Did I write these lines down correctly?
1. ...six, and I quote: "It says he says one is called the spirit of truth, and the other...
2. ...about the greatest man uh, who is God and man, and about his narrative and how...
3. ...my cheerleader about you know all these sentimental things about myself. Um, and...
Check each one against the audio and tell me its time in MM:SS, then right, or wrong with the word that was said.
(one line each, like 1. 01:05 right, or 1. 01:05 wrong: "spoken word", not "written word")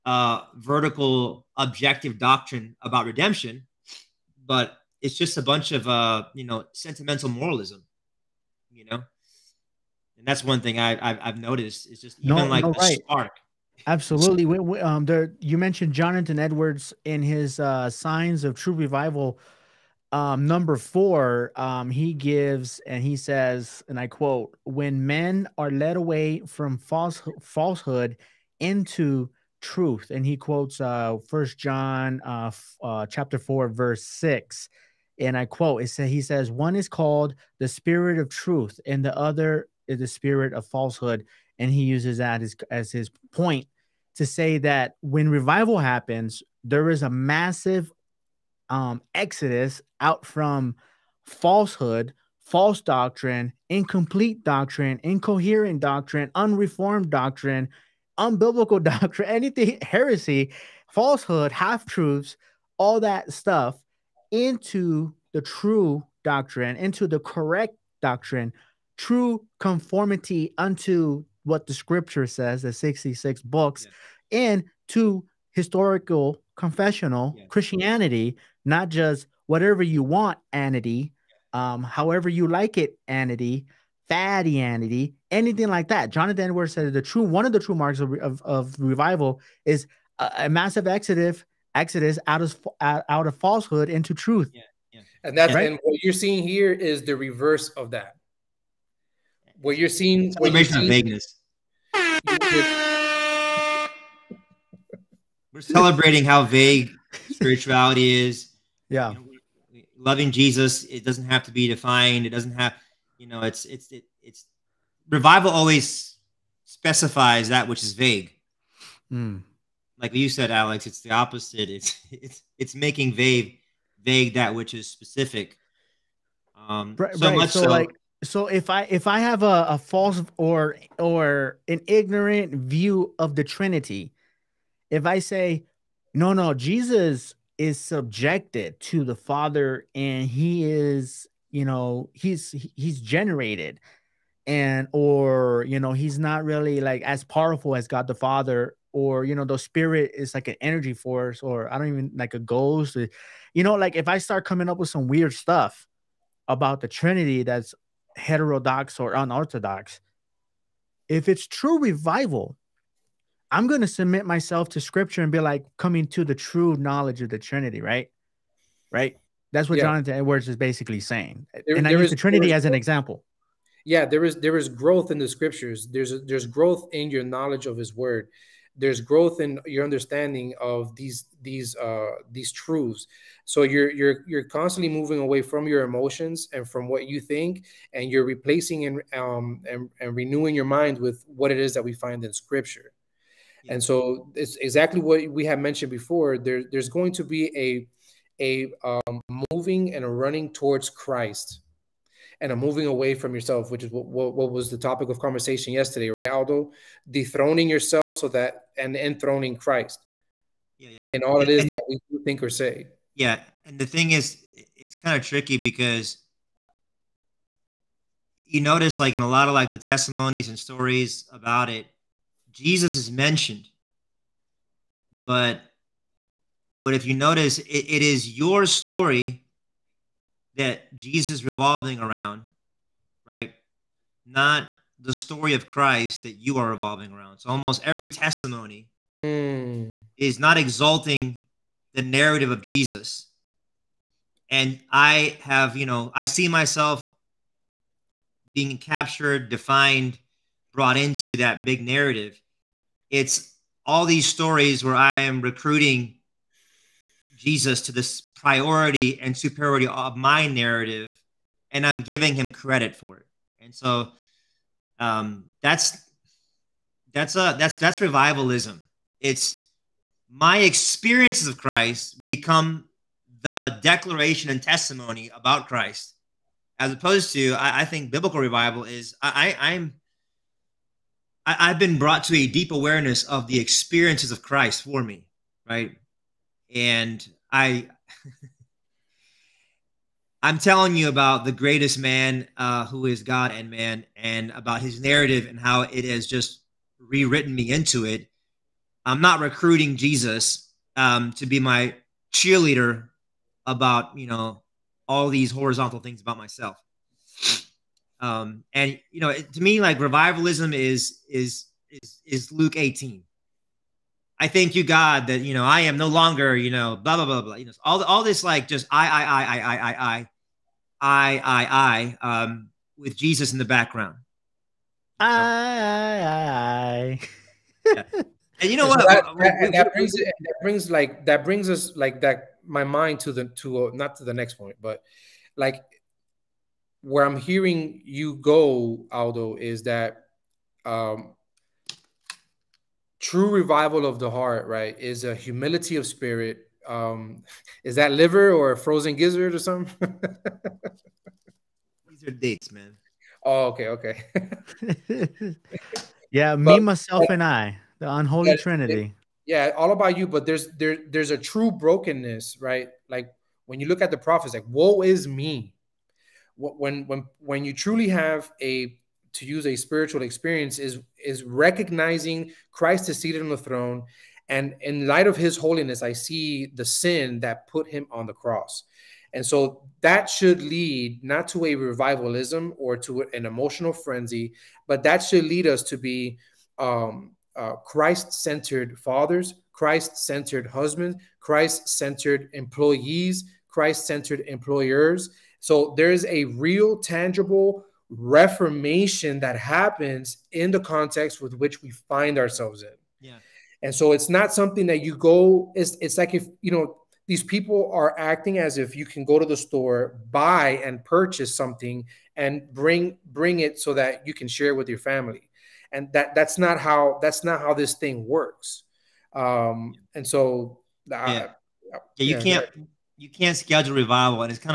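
1. 00:34 right
2. 04:51 right
3. 05:01 wrong: "horizontal", not "sentimental".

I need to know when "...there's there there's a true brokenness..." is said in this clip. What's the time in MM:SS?
06:00.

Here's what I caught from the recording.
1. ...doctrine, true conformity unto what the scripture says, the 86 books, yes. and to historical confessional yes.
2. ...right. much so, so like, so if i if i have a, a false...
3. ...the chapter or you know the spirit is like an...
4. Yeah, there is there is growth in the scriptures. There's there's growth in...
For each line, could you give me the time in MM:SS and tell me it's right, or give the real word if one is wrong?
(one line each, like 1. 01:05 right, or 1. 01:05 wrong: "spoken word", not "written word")
1. 01:08 wrong: "66", not "86"
2. 02:07 right
3. 02:28 wrong: "father", not "chapter"
4. 02:53 right.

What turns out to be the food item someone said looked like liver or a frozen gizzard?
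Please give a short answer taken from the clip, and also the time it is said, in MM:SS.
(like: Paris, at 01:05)
Dates, at 05:52.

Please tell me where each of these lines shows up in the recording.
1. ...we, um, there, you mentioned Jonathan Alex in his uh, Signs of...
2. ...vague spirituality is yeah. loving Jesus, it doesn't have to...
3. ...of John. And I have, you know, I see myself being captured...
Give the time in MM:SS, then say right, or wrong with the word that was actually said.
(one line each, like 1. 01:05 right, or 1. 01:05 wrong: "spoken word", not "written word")
1. 00:14 wrong: "Edwards", not "Alex"
2. 01:46 right
3. 04:02 wrong: "Jesus", not "John".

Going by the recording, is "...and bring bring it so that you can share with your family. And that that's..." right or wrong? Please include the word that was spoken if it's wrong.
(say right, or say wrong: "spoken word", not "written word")
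right.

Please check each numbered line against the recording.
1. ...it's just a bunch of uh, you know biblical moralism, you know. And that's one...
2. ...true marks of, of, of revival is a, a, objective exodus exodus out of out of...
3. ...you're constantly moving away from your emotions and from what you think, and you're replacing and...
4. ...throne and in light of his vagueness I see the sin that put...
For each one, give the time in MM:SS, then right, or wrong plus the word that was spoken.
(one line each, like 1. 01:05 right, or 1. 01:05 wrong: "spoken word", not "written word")
1. 00:05 wrong: "sentimental", not "biblical"
2. 01:27 wrong: "massive", not "objective"
3. 03:04 right
4. 06:13 wrong: "holiness", not "vagueness".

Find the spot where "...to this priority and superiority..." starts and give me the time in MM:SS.
04:17.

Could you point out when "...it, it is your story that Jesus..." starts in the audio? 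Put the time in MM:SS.
03:47.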